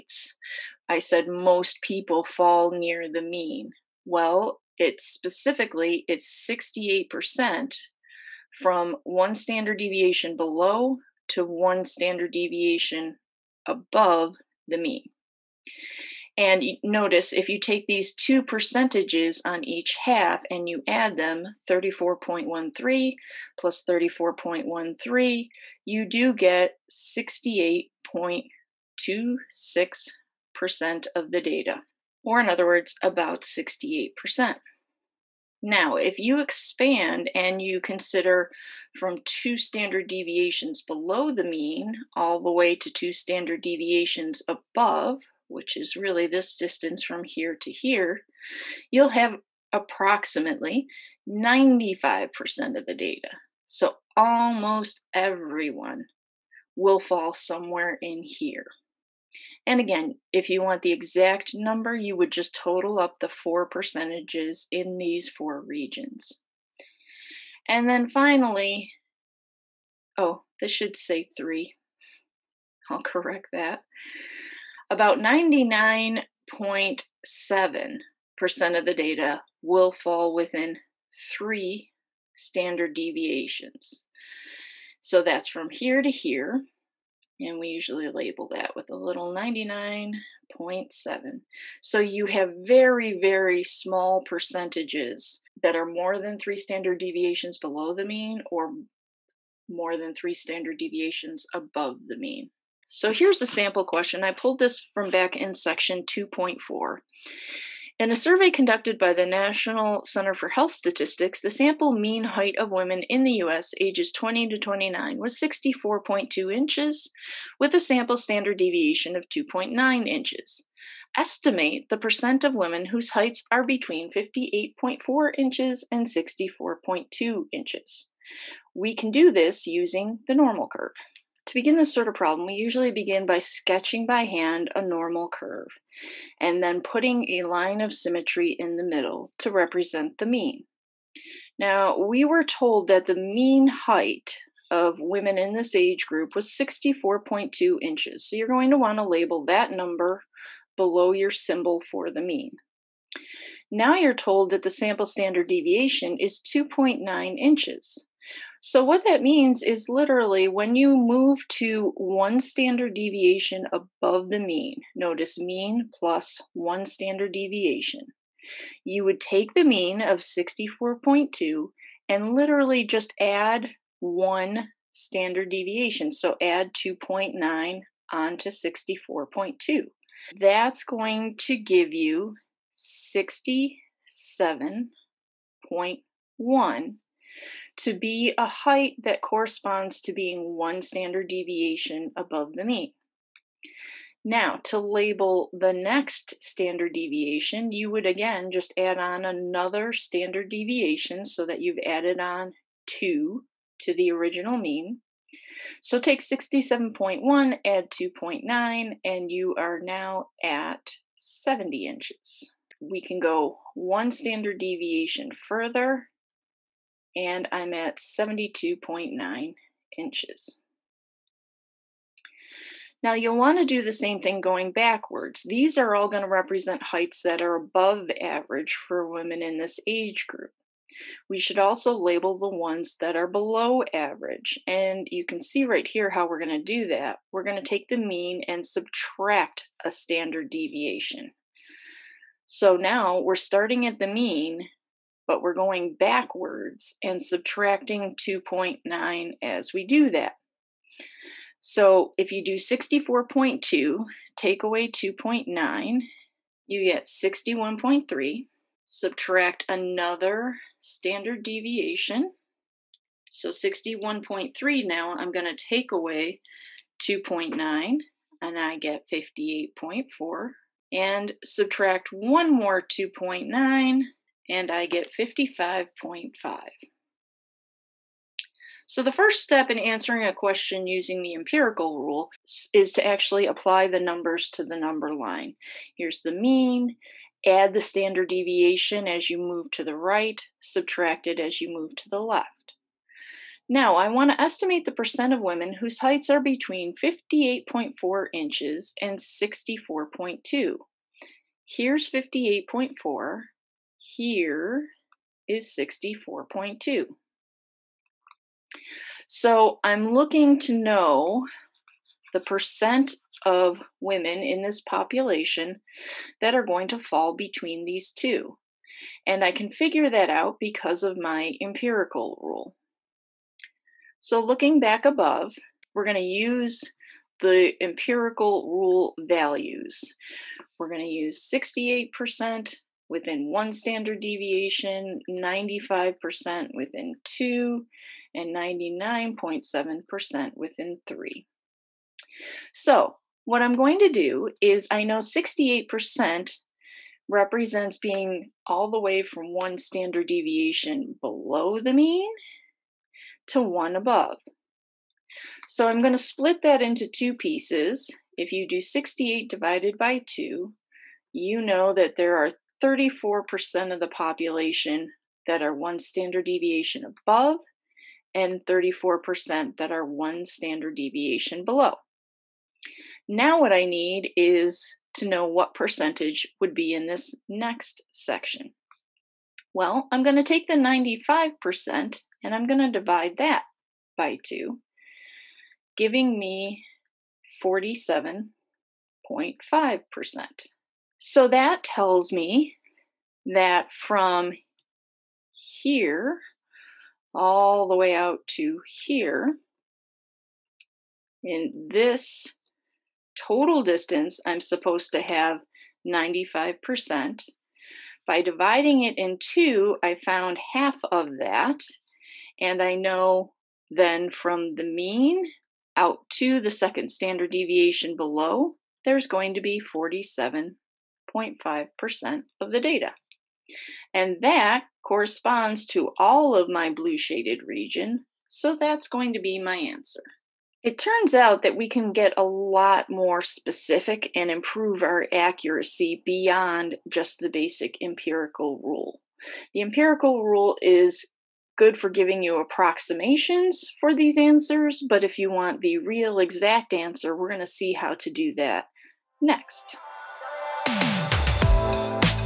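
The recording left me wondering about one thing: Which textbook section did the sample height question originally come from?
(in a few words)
2.4.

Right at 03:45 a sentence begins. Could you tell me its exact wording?
These are all going to represent heights that are above average for women in this age group.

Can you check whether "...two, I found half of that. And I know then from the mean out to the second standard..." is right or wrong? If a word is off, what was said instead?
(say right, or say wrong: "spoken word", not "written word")
right.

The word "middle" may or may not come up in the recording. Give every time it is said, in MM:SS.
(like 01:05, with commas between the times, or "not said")
02:18.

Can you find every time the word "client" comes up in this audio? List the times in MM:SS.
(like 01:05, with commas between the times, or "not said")
not said.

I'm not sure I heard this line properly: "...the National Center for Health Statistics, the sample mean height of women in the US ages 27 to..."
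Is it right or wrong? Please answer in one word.
wrong.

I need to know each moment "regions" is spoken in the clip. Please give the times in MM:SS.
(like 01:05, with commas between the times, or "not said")
01:05, 07:07.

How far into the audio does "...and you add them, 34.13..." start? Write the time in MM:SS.
00:20.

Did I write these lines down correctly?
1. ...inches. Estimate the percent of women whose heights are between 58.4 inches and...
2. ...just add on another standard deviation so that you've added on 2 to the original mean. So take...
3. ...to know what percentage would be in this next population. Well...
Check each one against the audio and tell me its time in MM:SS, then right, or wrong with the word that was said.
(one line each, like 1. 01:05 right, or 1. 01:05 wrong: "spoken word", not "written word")
1. 02:00 right
2. 03:18 right
3. 06:15 wrong: "section", not "population".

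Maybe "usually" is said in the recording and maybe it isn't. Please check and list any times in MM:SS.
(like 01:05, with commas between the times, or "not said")
01:27, 02:12.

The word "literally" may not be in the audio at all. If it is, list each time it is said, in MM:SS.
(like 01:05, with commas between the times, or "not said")
02:39, 02:52.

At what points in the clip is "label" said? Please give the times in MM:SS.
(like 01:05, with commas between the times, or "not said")
01:28, 02:29, 03:14, 03:51.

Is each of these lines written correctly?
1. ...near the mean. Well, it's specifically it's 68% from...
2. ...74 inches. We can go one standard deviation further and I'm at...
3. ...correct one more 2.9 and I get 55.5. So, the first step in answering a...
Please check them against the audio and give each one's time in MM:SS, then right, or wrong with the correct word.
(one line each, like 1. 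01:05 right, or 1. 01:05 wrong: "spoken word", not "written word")
1. 00:02 right
2. 03:31 wrong: "70", not "74"
3. 04:31 wrong: "subtract", not "correct".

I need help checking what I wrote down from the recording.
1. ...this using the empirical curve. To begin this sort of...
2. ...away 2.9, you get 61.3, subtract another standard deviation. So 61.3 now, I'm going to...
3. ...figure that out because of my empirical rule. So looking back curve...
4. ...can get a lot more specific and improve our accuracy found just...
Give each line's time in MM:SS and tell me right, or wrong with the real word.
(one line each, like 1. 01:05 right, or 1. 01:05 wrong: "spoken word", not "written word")
1. 02:09 wrong: "normal", not "empirical"
2. 04:14 right
3. 05:19 wrong: "above", not "curve"
4. 07:11 wrong: "beyond", not "found".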